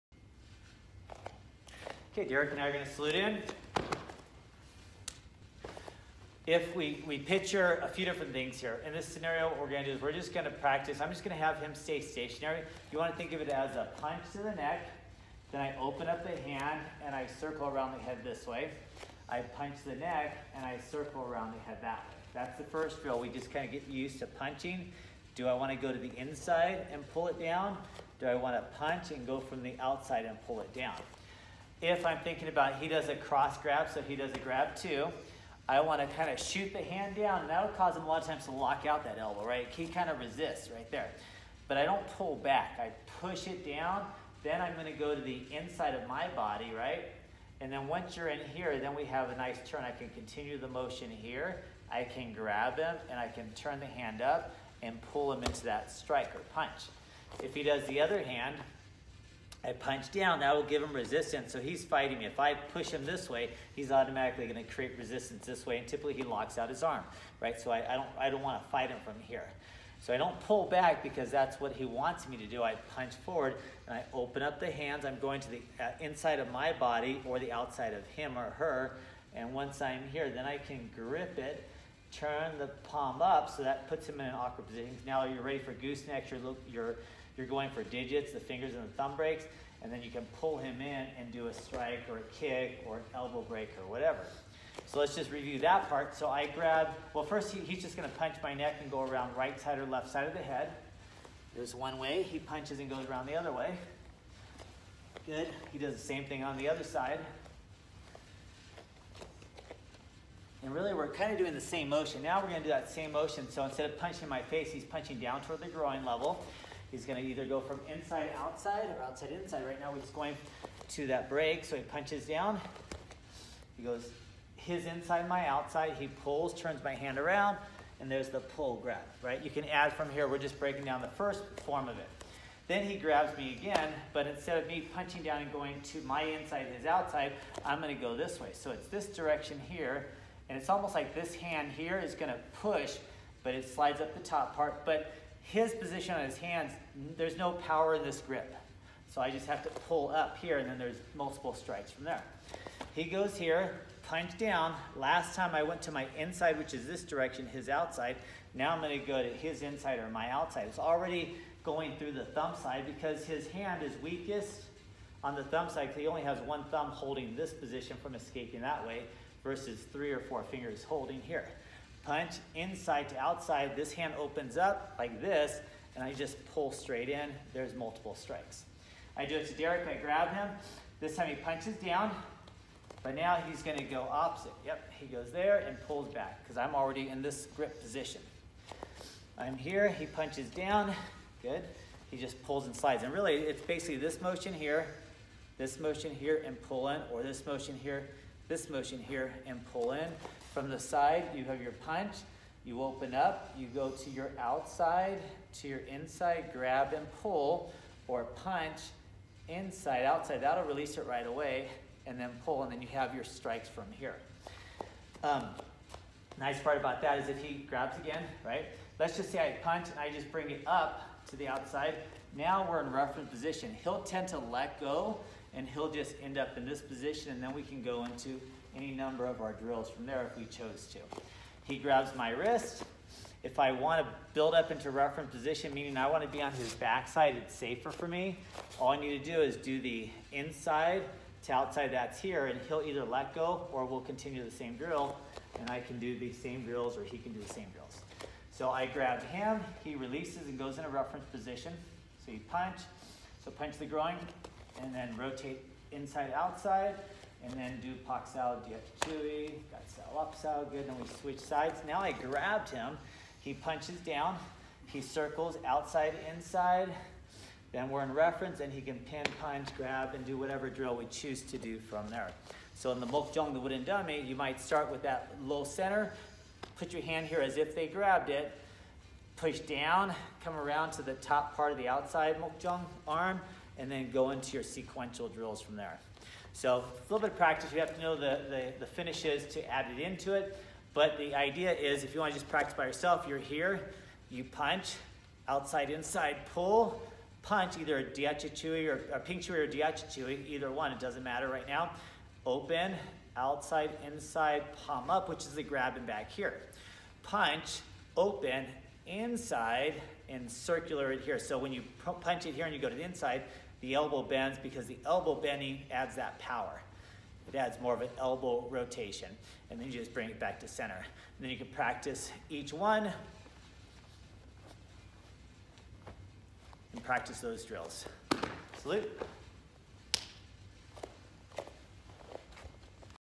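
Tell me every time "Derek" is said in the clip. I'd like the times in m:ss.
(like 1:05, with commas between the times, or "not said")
0:02, 2:59.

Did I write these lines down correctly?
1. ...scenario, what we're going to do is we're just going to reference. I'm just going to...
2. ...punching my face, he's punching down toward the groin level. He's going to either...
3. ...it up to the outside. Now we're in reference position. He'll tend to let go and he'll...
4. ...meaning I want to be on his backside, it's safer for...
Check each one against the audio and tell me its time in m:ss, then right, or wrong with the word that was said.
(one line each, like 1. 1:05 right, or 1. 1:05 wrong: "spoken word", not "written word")
1. 0:09 wrong: "practice", not "reference"
2. 1:53 right
3. 3:40 right
4. 3:55 right.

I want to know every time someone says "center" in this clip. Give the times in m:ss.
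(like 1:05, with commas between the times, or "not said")
4:35, 5:20.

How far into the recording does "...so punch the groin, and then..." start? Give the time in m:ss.
4:13.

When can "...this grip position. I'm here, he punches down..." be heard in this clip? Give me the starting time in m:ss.
3:07.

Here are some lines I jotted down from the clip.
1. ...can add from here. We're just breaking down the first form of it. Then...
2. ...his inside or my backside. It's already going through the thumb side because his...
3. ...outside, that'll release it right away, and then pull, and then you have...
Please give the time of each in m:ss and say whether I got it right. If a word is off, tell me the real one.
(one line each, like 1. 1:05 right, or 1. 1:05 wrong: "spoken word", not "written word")
1. 2:09 right
2. 2:39 wrong: "outside", not "backside"
3. 3:30 right.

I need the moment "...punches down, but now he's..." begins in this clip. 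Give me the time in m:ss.
3:01.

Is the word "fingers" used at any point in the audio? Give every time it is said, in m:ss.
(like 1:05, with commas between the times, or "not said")
1:28, 2:50.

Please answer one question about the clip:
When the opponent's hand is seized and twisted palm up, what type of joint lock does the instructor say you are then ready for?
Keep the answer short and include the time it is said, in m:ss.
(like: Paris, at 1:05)
Goosenecks, at 1:25.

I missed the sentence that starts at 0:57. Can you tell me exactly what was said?
If he does the other hand, I punch down, that will give him resistance.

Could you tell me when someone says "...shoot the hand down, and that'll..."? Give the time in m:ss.
0:36.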